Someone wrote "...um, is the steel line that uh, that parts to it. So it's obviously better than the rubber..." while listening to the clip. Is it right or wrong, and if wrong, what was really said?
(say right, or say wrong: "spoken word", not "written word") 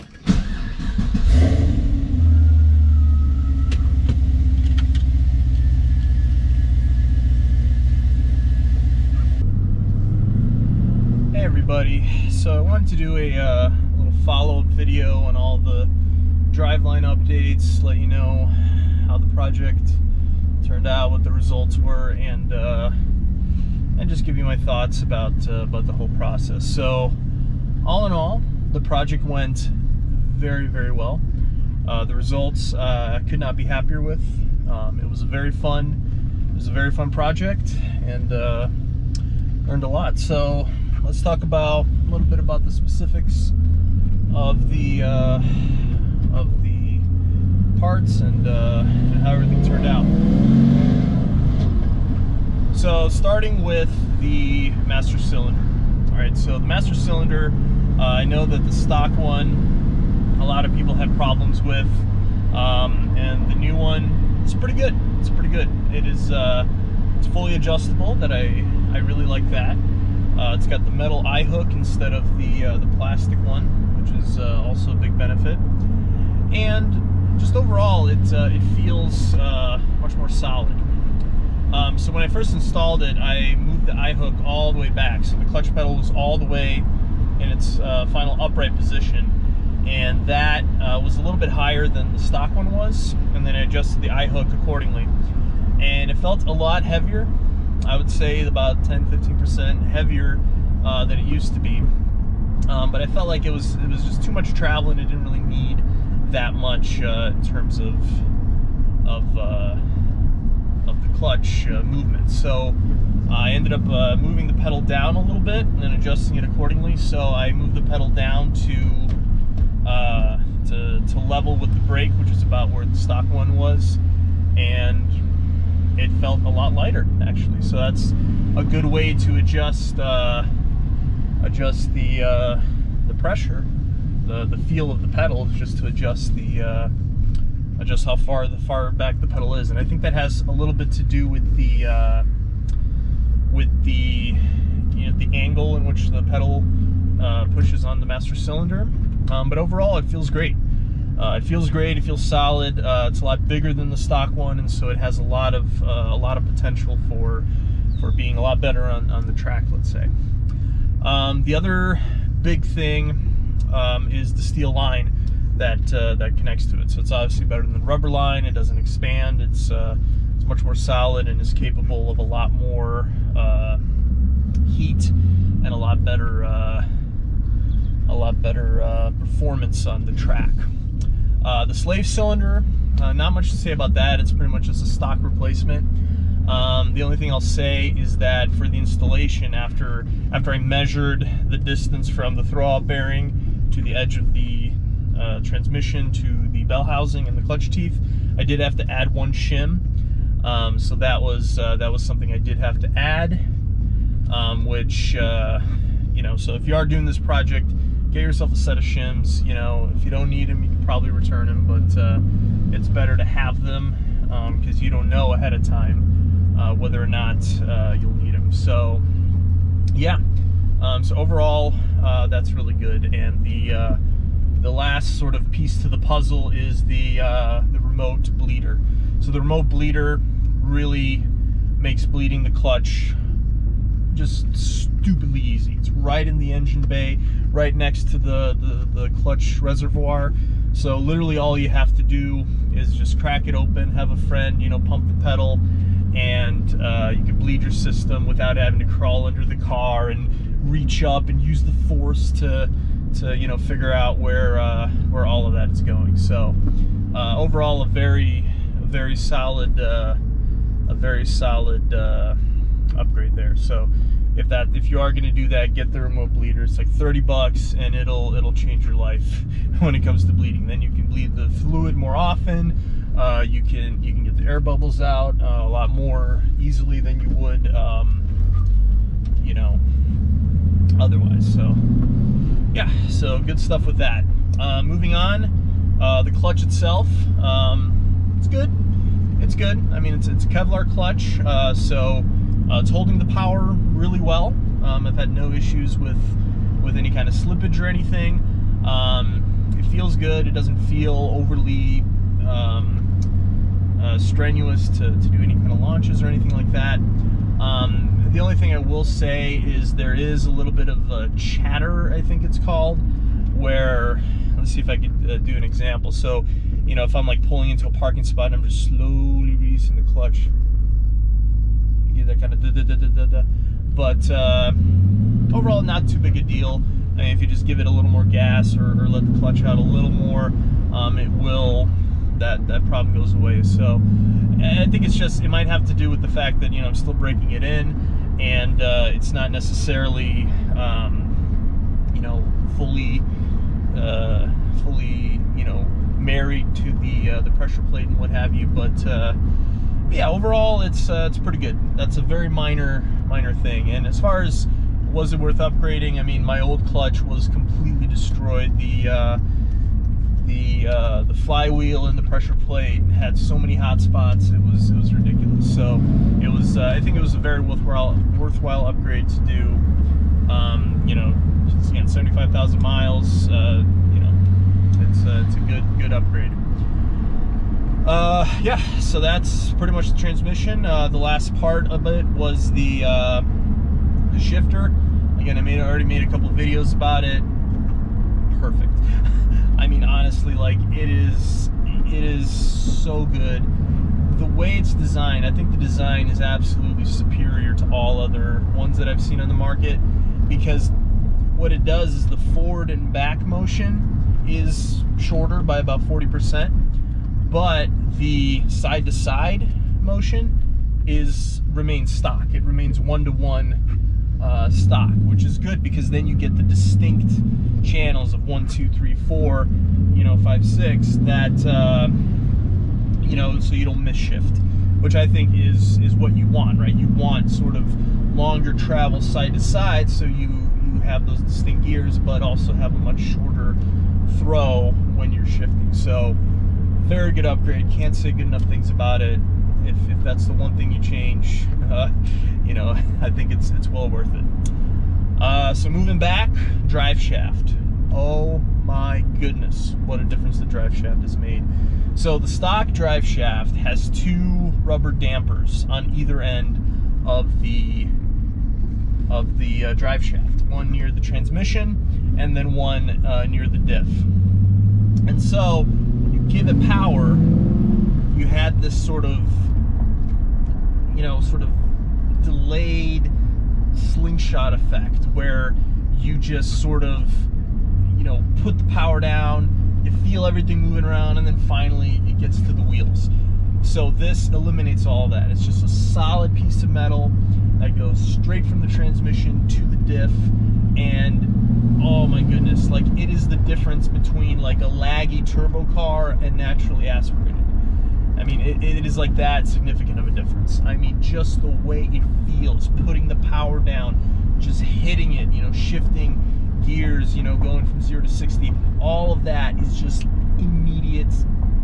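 wrong: "connects", not "parts".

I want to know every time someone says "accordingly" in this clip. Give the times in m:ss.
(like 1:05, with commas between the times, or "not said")
1:34, 1:56.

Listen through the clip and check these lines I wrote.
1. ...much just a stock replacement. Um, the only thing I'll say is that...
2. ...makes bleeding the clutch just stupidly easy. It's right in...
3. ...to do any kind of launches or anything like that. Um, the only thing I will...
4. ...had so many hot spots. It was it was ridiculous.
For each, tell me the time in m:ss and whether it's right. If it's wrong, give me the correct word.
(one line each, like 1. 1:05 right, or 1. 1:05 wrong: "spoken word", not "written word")
1. 3:04 right
2. 3:51 right
3. 5:05 right
4. 6:03 right.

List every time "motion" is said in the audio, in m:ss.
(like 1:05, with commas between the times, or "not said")
6:43, 6:50.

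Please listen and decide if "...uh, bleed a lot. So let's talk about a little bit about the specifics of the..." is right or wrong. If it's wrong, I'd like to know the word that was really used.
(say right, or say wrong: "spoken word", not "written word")
wrong: "learned", not "bleed".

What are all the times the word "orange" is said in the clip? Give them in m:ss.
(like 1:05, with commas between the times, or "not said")
not said.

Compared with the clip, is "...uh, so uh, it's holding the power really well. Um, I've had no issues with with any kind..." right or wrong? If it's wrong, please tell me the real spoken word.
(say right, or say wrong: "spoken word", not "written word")
right.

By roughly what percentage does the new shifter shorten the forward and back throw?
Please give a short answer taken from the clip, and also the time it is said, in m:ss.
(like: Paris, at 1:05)
40 percent, at 6:46.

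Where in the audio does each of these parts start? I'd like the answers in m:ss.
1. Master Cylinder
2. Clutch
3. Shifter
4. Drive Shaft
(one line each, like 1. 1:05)
1. 0:51
2. 4:43
3. 6:20
4. 7:25.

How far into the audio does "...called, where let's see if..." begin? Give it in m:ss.
5:12.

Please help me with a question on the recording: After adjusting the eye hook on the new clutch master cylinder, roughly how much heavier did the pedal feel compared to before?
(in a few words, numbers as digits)
10-15%.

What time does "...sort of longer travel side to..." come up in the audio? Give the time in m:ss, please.
7:07.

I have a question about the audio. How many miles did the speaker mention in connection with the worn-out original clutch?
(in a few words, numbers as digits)
75,000.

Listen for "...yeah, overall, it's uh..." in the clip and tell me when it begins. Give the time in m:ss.
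5:50.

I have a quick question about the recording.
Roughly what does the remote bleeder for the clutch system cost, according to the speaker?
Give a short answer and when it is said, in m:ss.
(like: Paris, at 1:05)
$30, at 4:26.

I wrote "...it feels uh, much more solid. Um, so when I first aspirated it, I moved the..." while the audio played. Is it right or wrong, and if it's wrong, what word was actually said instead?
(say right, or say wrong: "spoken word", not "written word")
wrong: "installed", not "aspirated".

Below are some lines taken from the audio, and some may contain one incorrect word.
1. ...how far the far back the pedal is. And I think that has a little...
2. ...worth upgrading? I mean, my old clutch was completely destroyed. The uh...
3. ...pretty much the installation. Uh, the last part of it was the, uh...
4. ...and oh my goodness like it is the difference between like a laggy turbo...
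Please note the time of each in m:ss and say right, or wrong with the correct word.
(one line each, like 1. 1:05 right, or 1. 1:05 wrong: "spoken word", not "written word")
1. 2:18 right
2. 5:55 right
3. 6:19 wrong: "transmission", not "installation"
4. 8:10 right.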